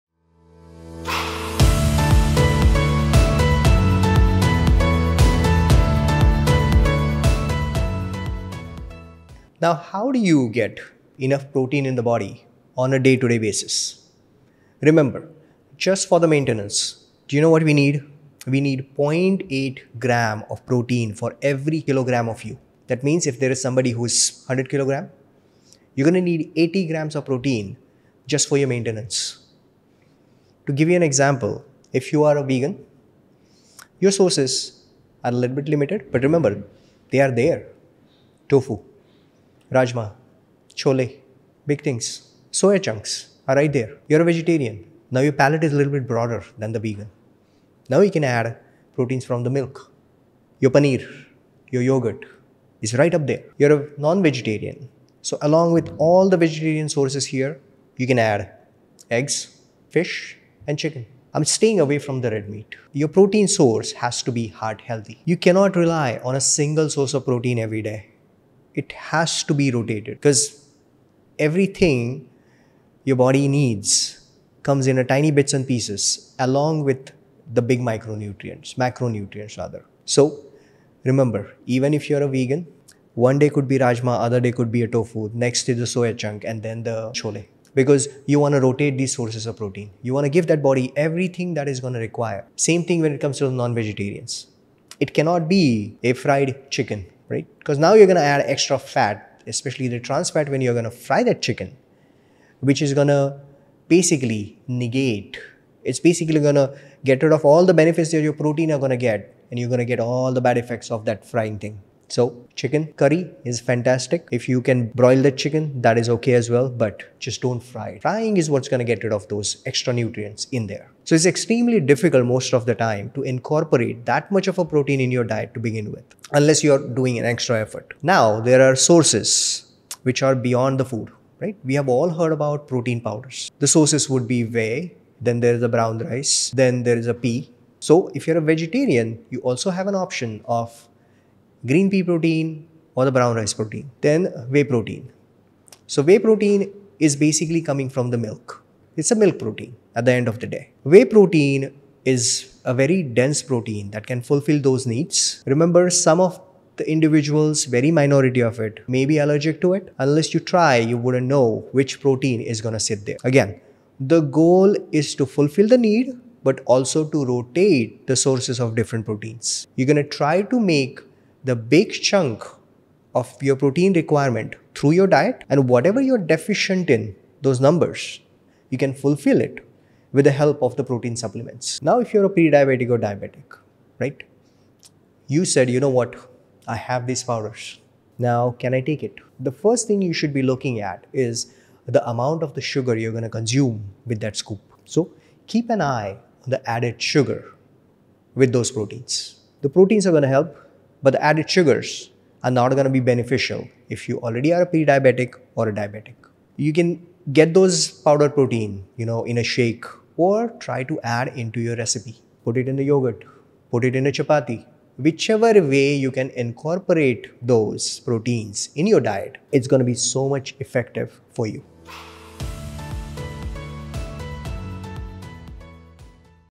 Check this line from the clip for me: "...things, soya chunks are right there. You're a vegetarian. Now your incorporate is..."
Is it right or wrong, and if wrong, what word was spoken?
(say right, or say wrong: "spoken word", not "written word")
wrong: "palate", not "incorporate".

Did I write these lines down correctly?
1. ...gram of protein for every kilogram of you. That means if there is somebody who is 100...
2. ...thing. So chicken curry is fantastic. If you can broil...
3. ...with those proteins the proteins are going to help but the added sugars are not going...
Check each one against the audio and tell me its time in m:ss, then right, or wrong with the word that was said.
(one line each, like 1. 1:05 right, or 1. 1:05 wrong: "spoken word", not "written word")
1. 0:19 right
2. 1:51 right
3. 3:18 right.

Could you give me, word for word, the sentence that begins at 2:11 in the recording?
We have all heard about protein powders.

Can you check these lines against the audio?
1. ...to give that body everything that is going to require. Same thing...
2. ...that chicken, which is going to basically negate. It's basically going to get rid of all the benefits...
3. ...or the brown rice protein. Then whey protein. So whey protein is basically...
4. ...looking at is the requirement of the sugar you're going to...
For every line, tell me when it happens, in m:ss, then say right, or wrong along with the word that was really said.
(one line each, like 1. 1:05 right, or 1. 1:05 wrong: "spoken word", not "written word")
1. 1:30 right
2. 1:41 right
3. 2:22 right
4. 3:10 wrong: "amount", not "requirement".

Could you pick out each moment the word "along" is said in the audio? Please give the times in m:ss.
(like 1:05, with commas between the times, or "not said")
0:55, 1:16.